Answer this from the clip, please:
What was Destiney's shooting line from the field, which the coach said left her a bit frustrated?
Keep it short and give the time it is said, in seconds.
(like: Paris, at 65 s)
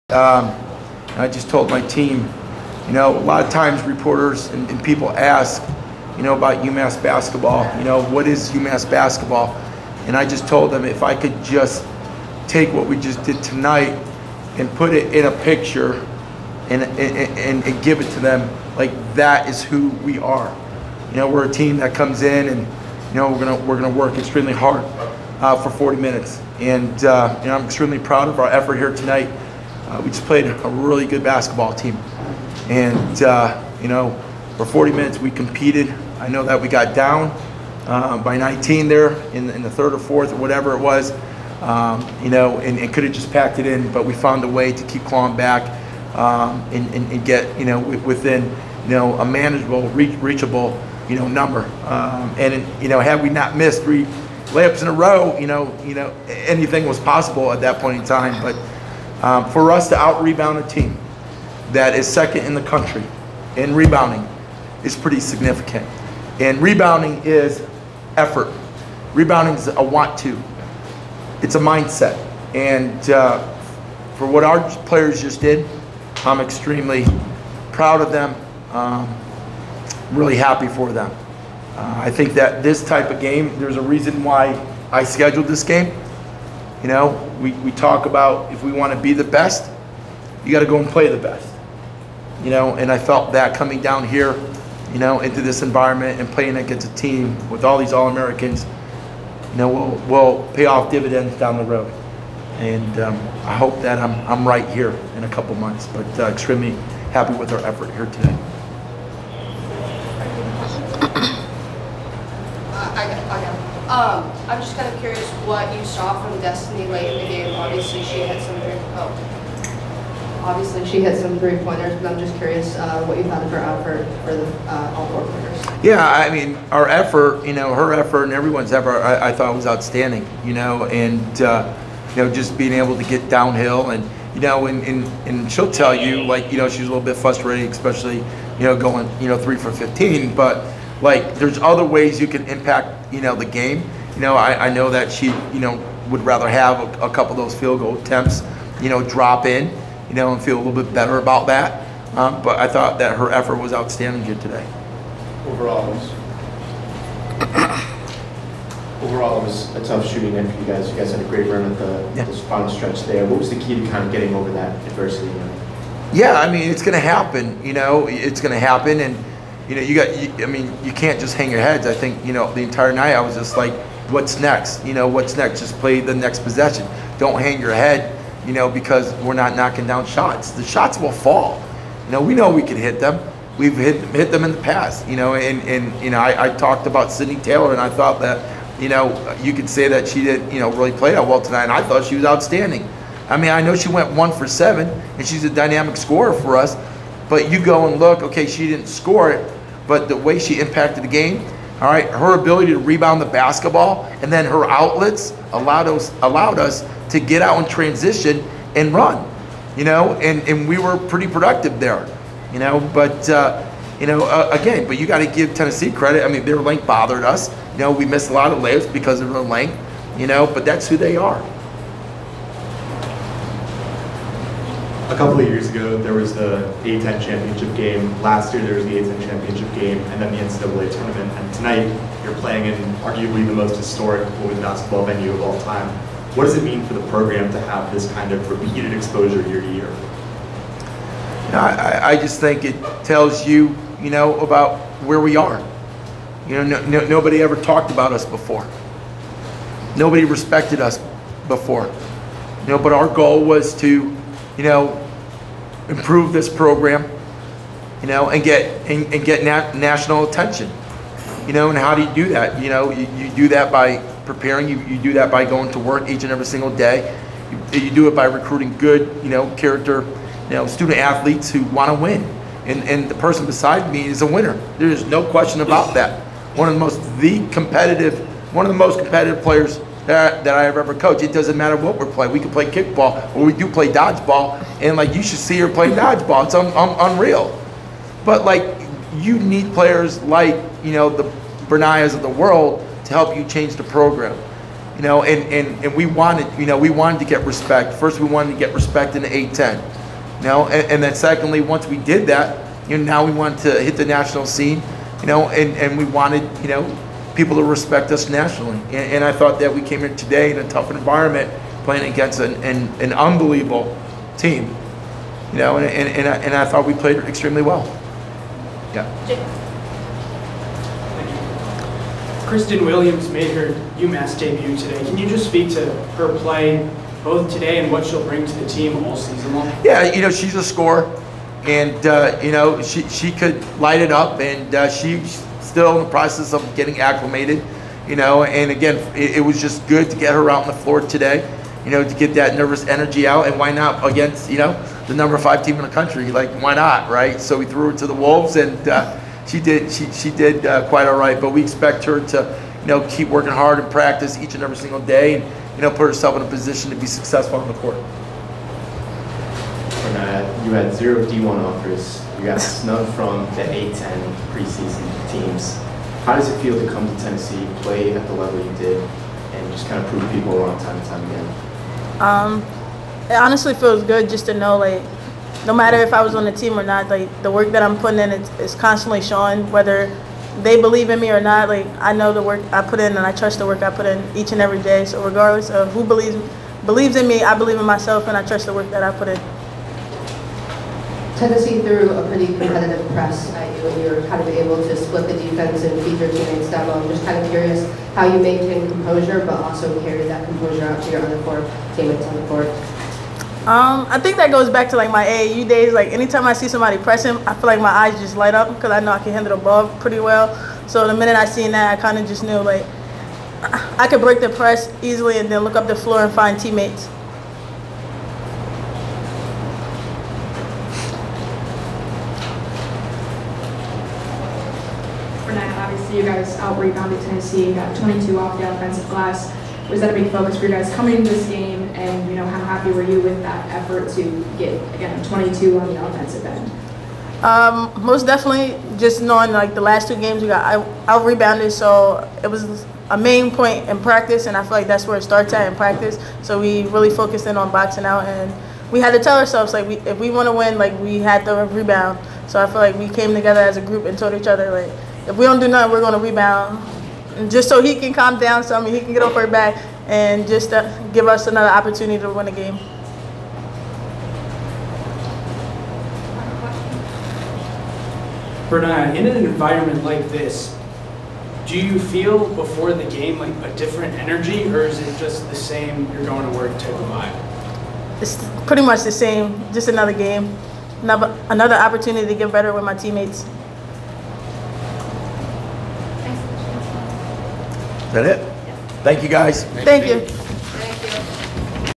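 3 for 15, at 139 s.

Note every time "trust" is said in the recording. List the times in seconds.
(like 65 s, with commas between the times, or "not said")
383 s, 388 s.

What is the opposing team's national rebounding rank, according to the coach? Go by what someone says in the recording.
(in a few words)
Second.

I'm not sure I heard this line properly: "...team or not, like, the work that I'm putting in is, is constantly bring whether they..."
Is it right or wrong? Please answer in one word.
wrong.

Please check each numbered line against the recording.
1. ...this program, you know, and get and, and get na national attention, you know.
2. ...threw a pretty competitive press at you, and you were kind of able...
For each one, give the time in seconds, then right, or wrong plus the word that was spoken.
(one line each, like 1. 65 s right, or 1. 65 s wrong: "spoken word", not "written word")
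1. 256 s right
2. 391 s right.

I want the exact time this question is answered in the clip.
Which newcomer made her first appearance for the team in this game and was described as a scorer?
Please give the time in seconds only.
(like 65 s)
322 s.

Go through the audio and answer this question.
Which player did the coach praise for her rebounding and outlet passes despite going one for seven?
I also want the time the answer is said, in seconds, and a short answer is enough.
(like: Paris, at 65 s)
Sydney Taylor, at 187 s.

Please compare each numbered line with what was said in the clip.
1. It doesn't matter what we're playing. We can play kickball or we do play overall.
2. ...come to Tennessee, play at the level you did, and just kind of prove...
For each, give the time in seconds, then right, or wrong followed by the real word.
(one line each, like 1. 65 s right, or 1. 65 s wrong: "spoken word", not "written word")
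1. 281 s wrong: "dodgeball", not "overall"
2. 366 s right.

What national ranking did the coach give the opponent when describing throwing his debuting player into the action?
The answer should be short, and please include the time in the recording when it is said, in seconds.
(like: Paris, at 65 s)
Number 5, at 345 s.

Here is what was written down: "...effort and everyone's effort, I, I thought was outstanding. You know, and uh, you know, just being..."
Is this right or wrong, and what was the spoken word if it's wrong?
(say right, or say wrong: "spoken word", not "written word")
right.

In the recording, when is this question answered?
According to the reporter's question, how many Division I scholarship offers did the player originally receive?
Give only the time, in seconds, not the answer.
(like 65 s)
360 s.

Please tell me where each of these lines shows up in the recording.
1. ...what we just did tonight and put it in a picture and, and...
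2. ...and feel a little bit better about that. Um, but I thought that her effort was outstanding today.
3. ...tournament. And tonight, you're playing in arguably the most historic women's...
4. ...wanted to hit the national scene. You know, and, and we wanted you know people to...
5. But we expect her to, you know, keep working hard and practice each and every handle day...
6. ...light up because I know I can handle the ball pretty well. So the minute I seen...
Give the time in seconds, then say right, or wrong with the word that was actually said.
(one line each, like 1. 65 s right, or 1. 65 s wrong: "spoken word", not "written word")
1. 12 s right
2. 150 s right
3. 230 s right
4. 303 s right
5. 351 s wrong: "single", not "handle"
6. 408 s right.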